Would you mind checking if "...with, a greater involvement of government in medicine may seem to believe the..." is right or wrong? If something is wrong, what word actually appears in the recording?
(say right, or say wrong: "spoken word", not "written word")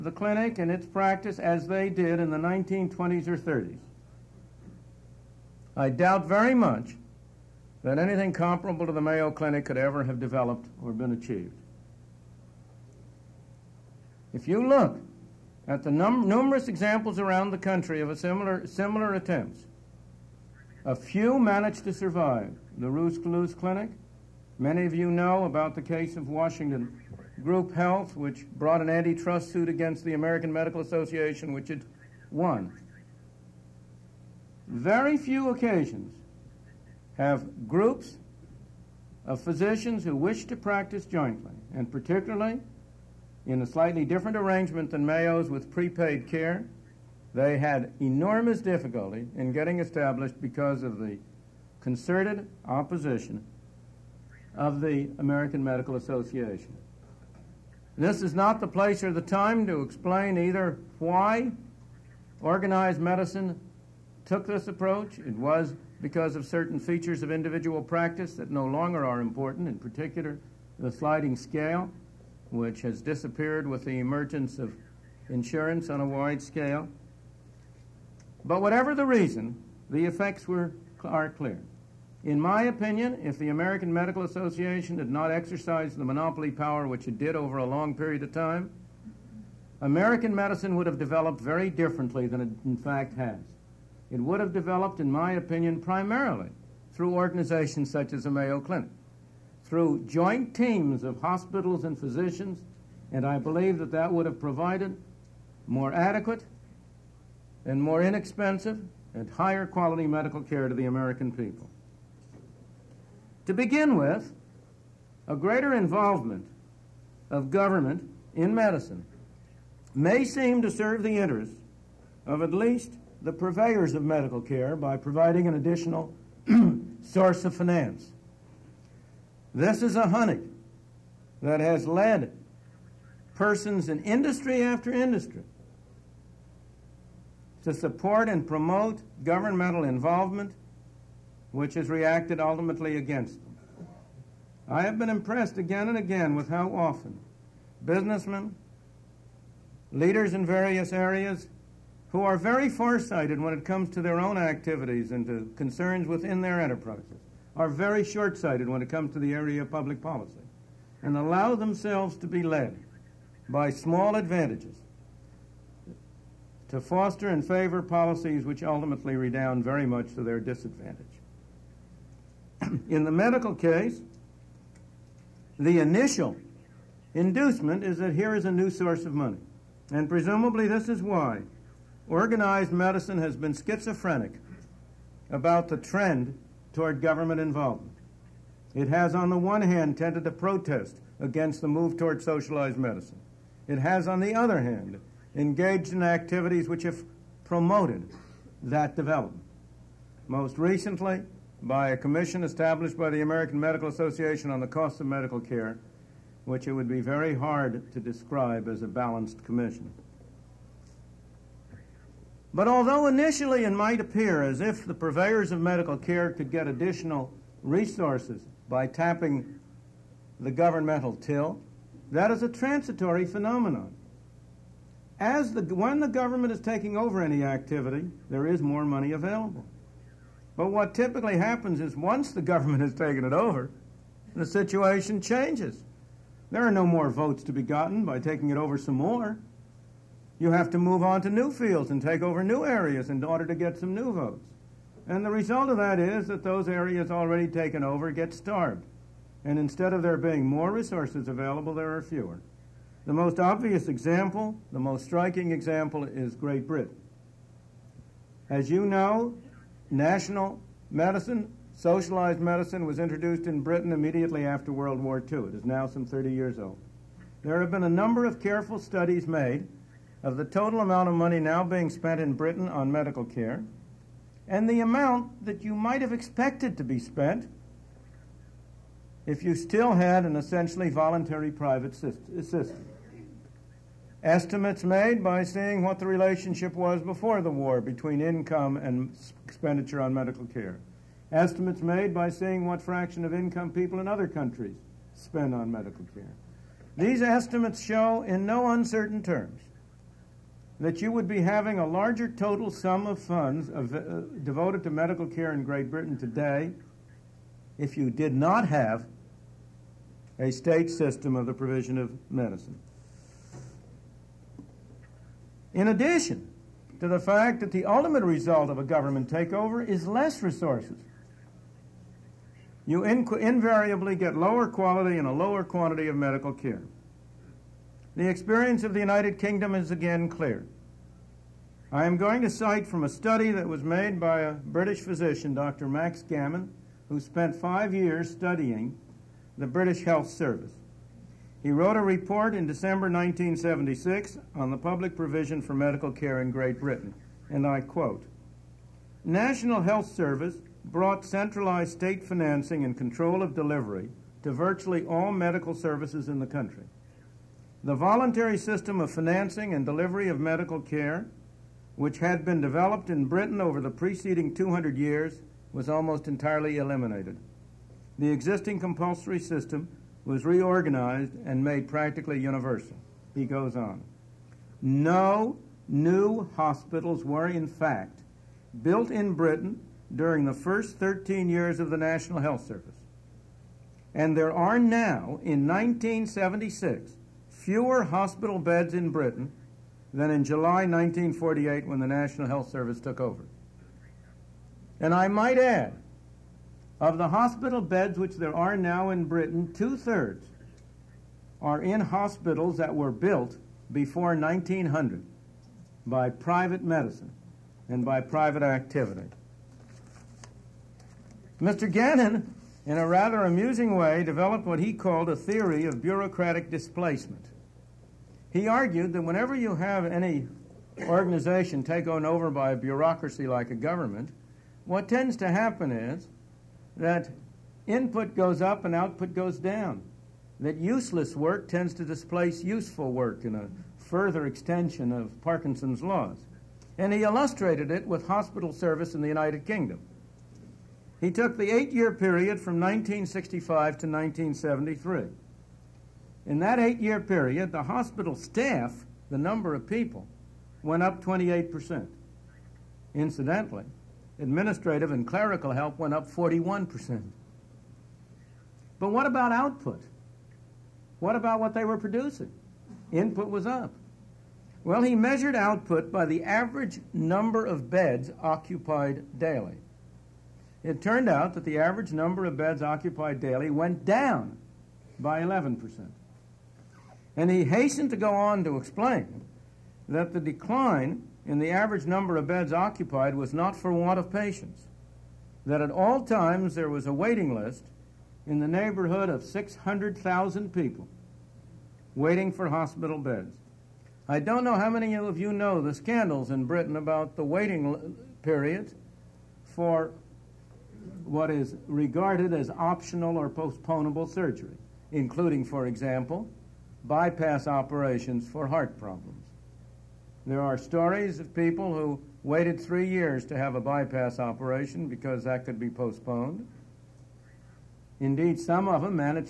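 wrong: "serve", not "believe".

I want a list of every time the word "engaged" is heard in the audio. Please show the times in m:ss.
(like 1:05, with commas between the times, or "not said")
3:15.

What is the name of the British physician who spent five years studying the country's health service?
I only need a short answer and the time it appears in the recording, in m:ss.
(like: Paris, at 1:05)
Max Gammon, at 5:35.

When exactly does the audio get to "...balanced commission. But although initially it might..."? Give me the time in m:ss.
3:28.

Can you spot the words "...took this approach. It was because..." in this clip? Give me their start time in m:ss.
1:04.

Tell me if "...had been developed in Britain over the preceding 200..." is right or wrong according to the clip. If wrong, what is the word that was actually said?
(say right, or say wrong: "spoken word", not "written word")
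right.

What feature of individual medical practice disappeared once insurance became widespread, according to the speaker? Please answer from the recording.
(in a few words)
sliding scale.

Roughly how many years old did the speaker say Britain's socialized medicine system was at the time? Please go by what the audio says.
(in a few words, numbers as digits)
30.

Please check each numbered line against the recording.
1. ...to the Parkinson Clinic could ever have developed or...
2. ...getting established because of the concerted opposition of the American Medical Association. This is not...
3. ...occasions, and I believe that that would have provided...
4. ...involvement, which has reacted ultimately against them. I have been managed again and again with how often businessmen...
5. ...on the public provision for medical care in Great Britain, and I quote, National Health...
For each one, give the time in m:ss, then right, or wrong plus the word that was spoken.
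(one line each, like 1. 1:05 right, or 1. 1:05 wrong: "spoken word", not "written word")
1. 0:08 wrong: "Mayo", not "Parkinson"
2. 0:49 right
3. 1:41 wrong: "physicians", not "occasions"
4. 2:19 wrong: "impressed", not "managed"
5. 5:44 right.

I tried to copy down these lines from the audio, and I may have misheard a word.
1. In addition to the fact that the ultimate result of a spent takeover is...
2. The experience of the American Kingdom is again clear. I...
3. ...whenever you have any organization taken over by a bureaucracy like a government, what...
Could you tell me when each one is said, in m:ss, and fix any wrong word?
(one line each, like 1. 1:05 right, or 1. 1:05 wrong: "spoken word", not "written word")
1. 5:15 wrong: "government", not "spent"
2. 5:28 wrong: "United", not "American"
3. 6:59 right.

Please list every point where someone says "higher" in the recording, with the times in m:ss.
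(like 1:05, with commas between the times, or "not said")
1:49.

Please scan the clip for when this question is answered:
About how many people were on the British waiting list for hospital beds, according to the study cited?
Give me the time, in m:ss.
8:09.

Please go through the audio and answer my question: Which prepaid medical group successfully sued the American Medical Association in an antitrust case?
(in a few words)
Washington Group Health.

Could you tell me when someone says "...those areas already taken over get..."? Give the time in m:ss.
4:06.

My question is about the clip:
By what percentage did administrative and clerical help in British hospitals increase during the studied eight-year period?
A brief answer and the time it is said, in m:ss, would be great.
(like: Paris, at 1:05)
41%, at 7:36.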